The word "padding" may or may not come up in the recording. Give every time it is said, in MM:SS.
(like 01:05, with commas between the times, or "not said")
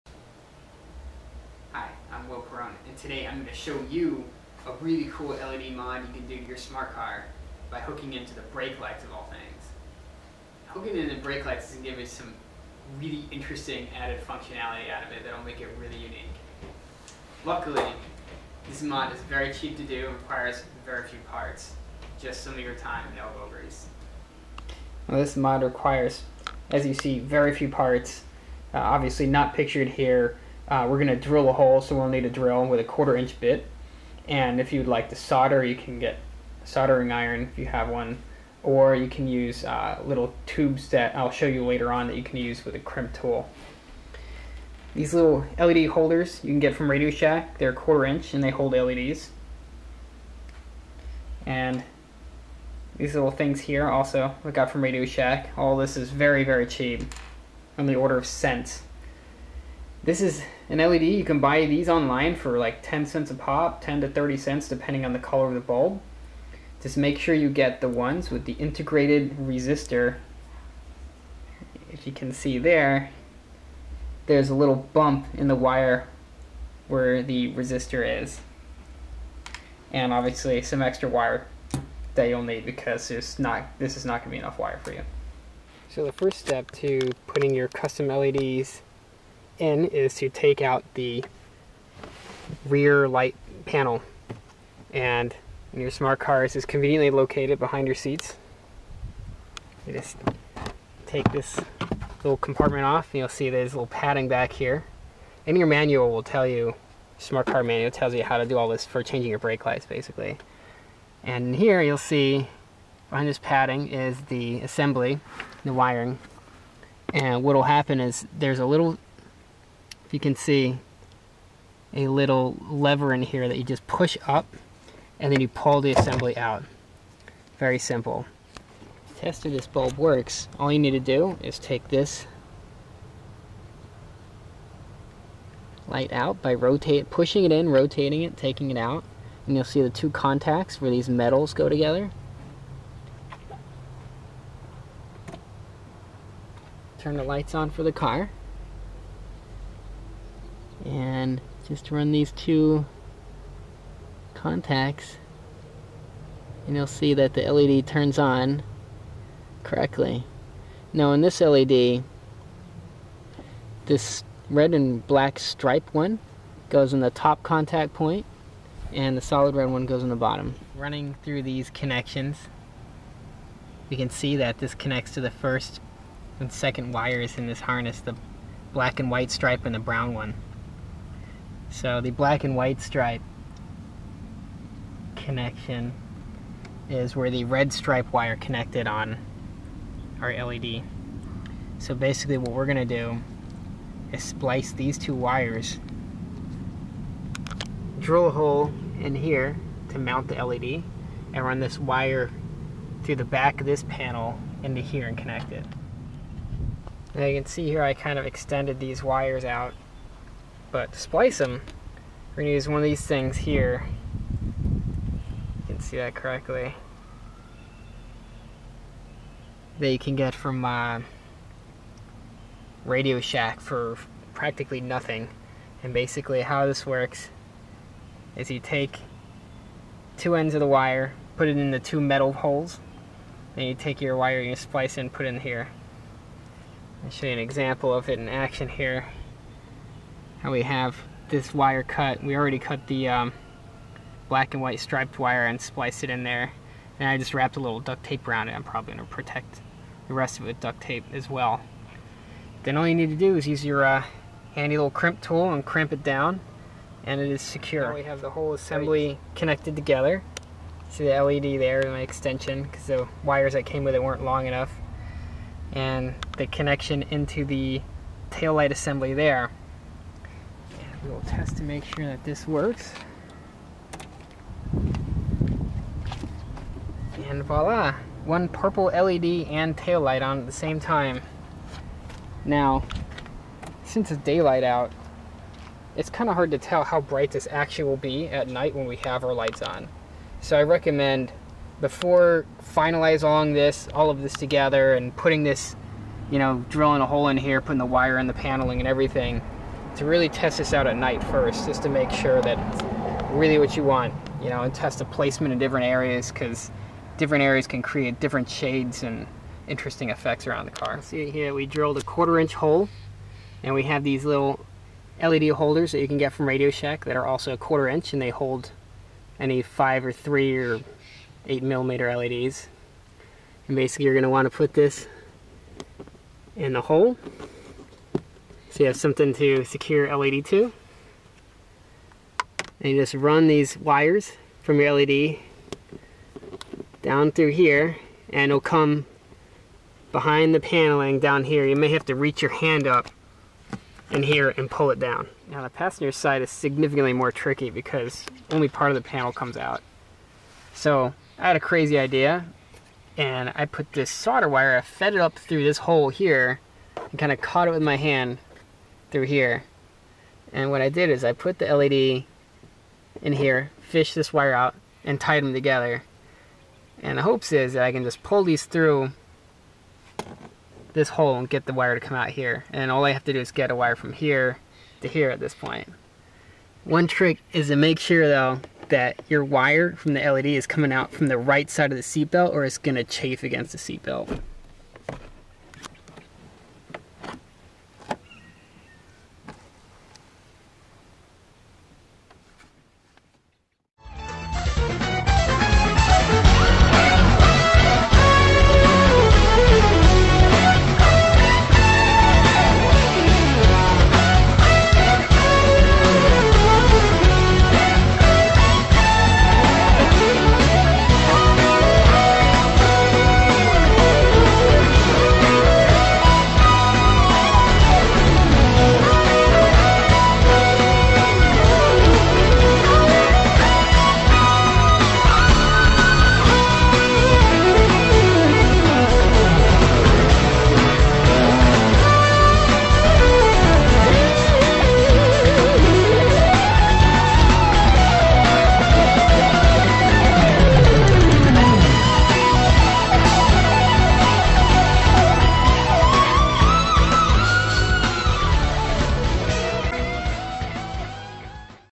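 01:43, 01:53.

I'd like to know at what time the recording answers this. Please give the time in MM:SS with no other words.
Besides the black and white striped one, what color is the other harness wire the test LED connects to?
02:59.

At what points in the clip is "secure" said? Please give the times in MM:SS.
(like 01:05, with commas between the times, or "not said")
04:17, 05:29.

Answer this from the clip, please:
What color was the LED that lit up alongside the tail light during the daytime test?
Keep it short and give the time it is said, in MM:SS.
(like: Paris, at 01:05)
purple, at 04:38.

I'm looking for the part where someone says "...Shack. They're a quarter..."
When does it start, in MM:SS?
00:47.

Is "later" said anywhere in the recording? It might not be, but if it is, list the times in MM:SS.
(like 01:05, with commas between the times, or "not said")
00:41.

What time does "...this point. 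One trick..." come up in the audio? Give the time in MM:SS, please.
06:15.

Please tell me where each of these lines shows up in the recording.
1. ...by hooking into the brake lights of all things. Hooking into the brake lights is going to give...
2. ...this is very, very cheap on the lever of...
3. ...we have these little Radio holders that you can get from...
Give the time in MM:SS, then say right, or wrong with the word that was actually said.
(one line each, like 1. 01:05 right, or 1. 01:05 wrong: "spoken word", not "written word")
1. 00:07 right
2. 00:55 wrong: "order", not "lever"
3. 05:13 wrong: "LED", not "Radio".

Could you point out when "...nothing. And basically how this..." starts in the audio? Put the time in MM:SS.
03:44.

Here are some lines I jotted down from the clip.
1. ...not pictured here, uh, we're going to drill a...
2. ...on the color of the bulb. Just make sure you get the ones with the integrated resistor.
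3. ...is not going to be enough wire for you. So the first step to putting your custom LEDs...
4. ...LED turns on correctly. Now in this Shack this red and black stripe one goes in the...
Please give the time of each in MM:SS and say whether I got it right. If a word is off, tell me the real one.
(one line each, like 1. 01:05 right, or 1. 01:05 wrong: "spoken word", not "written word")
1. 00:29 right
2. 01:05 right
3. 01:23 right
4. 02:37 wrong: "LED", not "Shack".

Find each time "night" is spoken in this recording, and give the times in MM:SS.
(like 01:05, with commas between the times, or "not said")
04:48, 05:00.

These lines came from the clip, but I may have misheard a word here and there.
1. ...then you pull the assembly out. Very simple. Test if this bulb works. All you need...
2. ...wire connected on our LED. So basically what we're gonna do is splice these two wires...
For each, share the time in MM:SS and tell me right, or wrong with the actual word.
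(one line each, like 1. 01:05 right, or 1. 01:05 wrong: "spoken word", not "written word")
1. 02:05 right
2. 03:08 right.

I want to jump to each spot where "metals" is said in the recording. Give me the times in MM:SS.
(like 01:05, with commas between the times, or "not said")
02:21, 03:51.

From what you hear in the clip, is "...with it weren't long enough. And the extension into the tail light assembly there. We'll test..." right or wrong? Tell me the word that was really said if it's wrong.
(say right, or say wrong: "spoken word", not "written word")
wrong: "connection", not "extension".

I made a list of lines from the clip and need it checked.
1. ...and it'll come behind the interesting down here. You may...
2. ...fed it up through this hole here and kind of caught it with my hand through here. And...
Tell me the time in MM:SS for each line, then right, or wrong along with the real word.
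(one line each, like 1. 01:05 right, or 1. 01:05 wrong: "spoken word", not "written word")
1. 05:38 wrong: "paneling", not "interesting"
2. 05:54 right.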